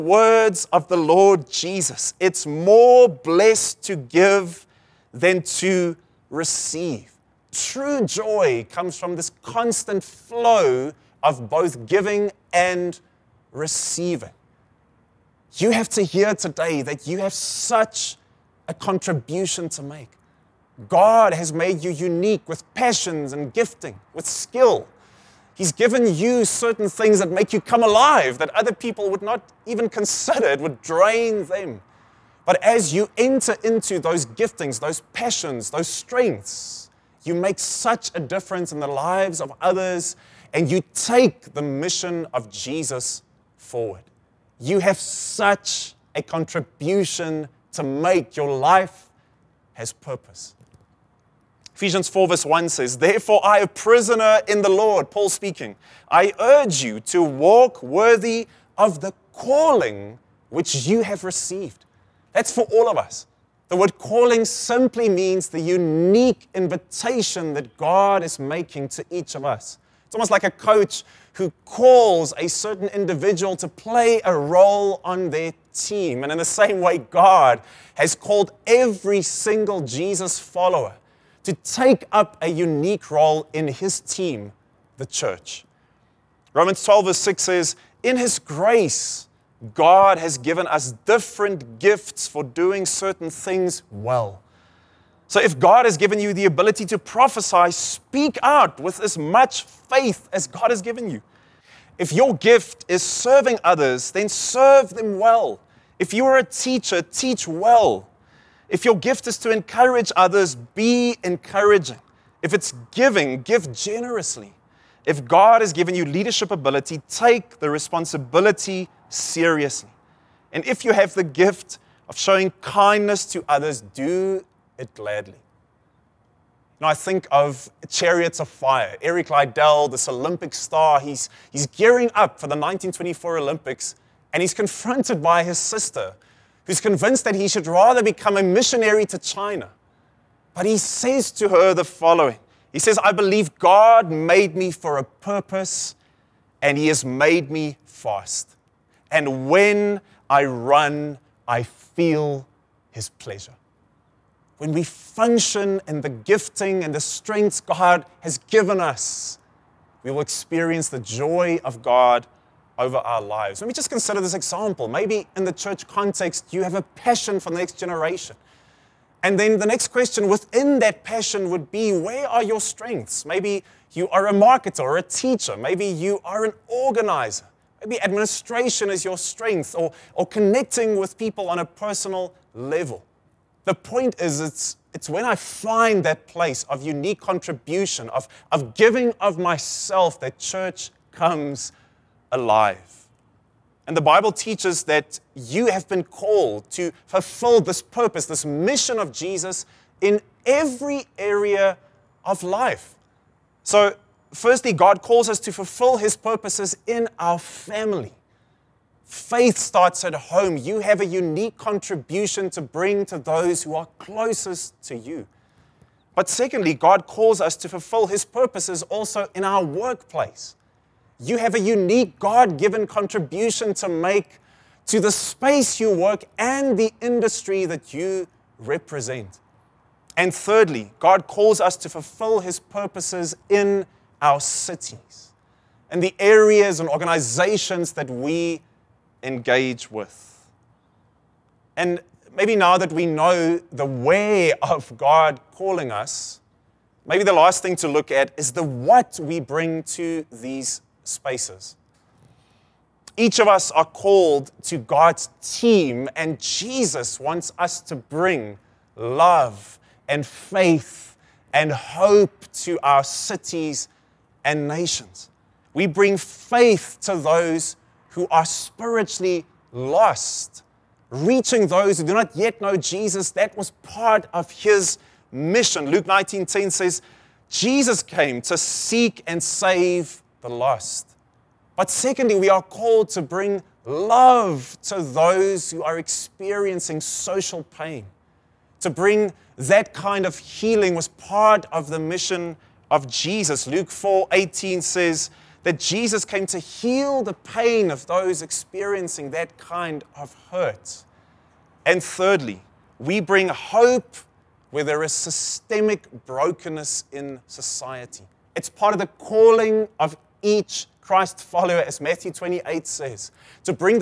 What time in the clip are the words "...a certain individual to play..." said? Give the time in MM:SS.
01:12.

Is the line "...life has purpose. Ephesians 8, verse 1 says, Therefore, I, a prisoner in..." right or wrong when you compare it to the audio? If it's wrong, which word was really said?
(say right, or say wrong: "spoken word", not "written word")
wrong: "4", not "8".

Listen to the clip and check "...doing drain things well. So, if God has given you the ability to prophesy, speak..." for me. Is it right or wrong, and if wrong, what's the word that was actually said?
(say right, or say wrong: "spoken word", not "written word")
wrong: "certain", not "drain".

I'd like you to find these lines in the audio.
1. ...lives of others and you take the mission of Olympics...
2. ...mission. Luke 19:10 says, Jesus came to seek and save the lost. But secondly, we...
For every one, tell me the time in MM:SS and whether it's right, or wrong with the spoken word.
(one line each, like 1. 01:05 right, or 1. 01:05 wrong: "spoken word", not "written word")
1. 00:38 wrong: "Jesus", not "Olympics"
2. 04:35 right.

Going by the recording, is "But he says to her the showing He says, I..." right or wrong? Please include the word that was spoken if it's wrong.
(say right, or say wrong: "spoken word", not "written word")
wrong: "following", not "showing".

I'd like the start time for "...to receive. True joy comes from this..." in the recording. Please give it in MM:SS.
00:05.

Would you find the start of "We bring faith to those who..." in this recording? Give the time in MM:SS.
04:25.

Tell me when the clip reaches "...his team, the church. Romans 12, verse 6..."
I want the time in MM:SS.
01:23.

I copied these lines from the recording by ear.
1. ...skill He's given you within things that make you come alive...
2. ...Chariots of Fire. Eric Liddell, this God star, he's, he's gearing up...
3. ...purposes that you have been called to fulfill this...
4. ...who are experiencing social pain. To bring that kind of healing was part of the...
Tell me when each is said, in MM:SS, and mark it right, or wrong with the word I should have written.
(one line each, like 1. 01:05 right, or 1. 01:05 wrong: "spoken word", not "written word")
1. 00:24 wrong: "certain", not "within"
2. 02:07 wrong: "Olympic", not "God"
3. 03:14 wrong: "teaches", not "purposes"
4. 04:45 right.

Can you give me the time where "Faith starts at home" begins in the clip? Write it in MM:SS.
03:29.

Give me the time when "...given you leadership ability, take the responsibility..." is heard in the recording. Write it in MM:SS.
01:55.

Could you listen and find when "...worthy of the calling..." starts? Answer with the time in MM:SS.
00:57.